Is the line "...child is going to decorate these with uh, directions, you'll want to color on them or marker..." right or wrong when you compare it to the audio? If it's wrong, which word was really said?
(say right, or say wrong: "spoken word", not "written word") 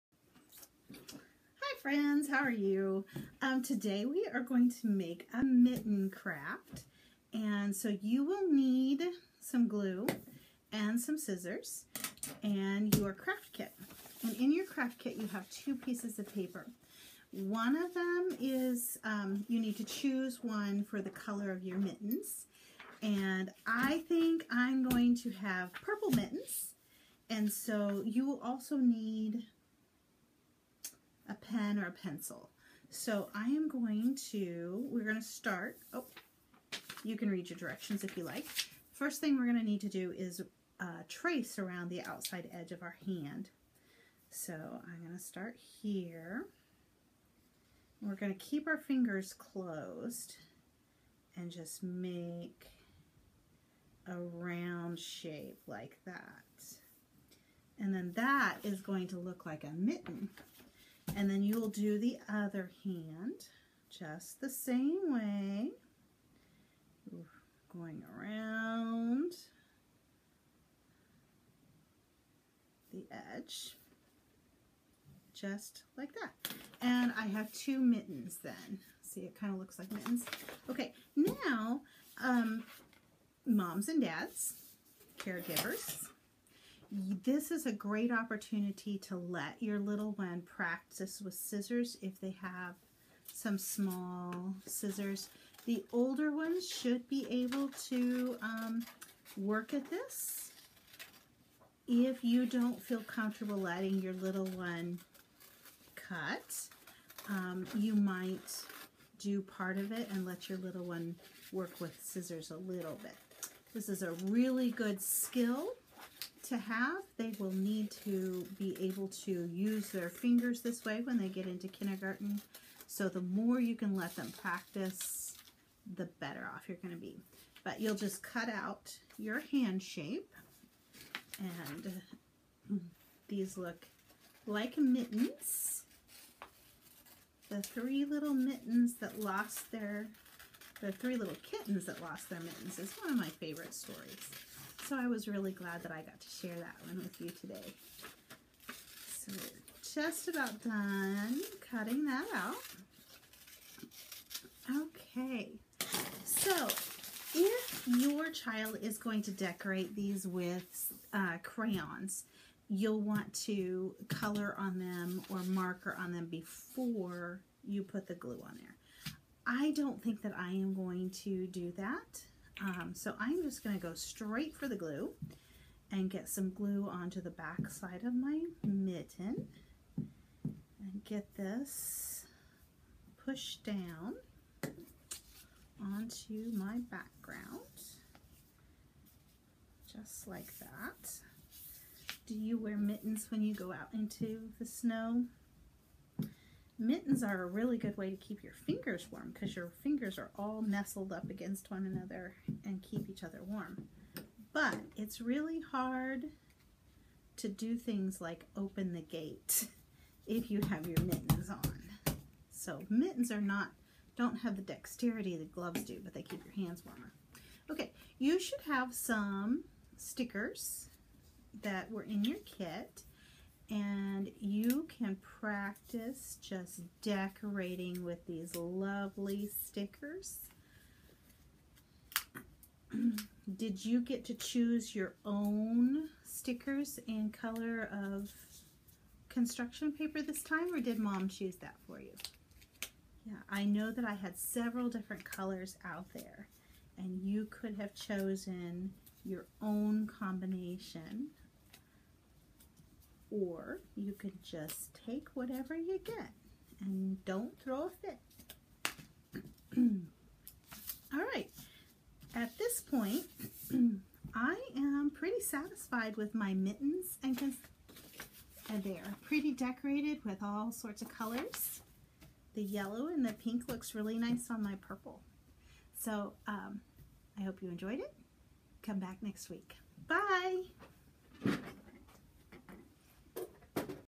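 wrong: "crayons", not "directions".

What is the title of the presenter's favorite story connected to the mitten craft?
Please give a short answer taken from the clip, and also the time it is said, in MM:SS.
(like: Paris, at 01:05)
The Three Little Kittens That Lost Their Mittens, at 02:20.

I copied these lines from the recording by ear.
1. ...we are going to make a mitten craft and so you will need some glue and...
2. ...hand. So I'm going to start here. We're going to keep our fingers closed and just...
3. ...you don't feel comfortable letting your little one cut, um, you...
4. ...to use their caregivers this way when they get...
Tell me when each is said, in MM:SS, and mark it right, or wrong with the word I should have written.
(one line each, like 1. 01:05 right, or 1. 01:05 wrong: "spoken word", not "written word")
1. 00:04 right
2. 00:43 right
3. 01:42 right
4. 01:59 wrong: "fingers", not "caregivers".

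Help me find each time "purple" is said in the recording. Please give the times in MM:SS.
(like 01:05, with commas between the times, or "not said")
00:25, 04:34.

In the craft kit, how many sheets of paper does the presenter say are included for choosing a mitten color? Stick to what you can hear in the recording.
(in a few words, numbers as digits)
2.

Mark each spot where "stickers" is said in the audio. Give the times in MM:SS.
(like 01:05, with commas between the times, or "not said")
03:39, 03:49, 03:56.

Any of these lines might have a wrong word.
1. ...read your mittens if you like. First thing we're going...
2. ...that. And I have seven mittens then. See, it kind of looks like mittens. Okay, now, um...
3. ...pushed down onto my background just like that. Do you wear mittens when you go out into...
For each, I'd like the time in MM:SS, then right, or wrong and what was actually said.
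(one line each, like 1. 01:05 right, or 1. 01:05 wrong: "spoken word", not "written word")
1. 00:37 wrong: "directions", not "mittens"
2. 01:16 wrong: "two", not "seven"
3. 03:03 right.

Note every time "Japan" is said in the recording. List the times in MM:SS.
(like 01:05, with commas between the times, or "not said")
not said.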